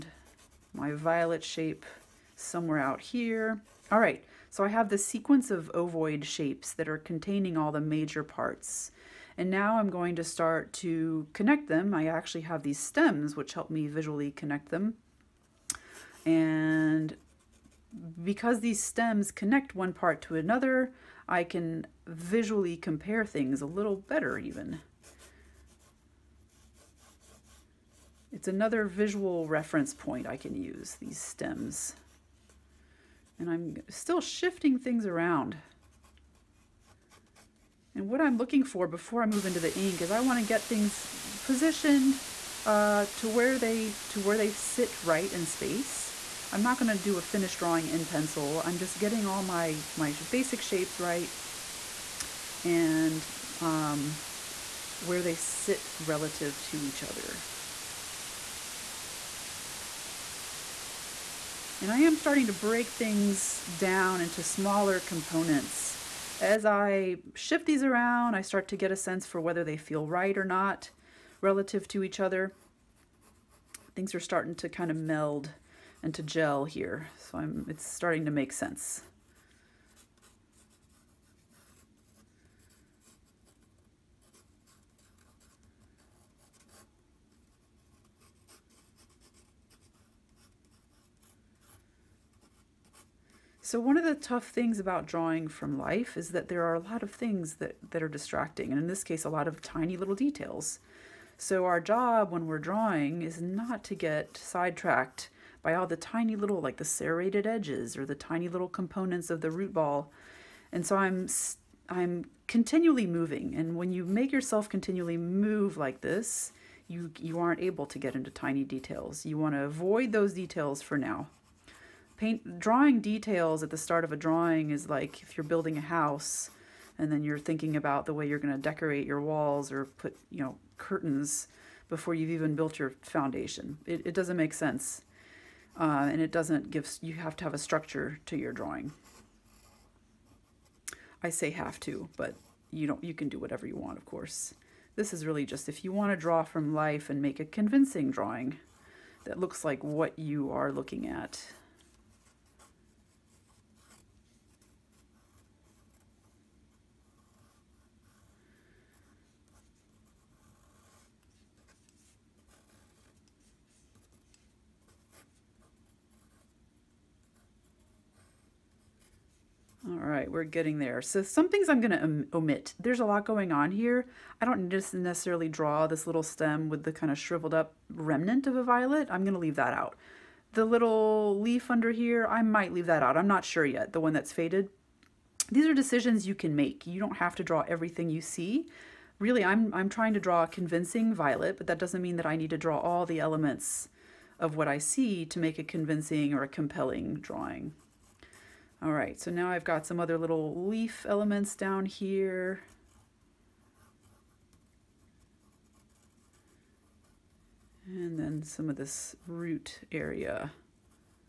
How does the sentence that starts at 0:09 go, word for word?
And now I'm going to start to connect them.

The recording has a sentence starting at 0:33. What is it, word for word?
And I'm still shifting things around.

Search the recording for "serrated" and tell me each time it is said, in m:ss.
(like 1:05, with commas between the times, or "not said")
1:46.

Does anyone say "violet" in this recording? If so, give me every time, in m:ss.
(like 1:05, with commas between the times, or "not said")
0:00, 2:58, 3:11.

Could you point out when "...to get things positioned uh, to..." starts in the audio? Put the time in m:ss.
0:40.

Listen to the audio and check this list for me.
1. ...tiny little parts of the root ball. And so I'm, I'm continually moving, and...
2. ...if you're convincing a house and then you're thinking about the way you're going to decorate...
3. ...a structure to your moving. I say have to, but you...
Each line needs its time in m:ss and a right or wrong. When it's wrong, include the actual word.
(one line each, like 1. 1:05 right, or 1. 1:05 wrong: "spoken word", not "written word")
1. 1:48 wrong: "components", not "parts"
2. 2:05 wrong: "building", not "convincing"
3. 2:17 wrong: "drawing", not "moving".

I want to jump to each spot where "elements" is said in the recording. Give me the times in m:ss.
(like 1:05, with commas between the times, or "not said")
3:13, 3:21.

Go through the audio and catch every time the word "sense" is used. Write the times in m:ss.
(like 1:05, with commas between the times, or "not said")
1:08, 1:18, 2:14.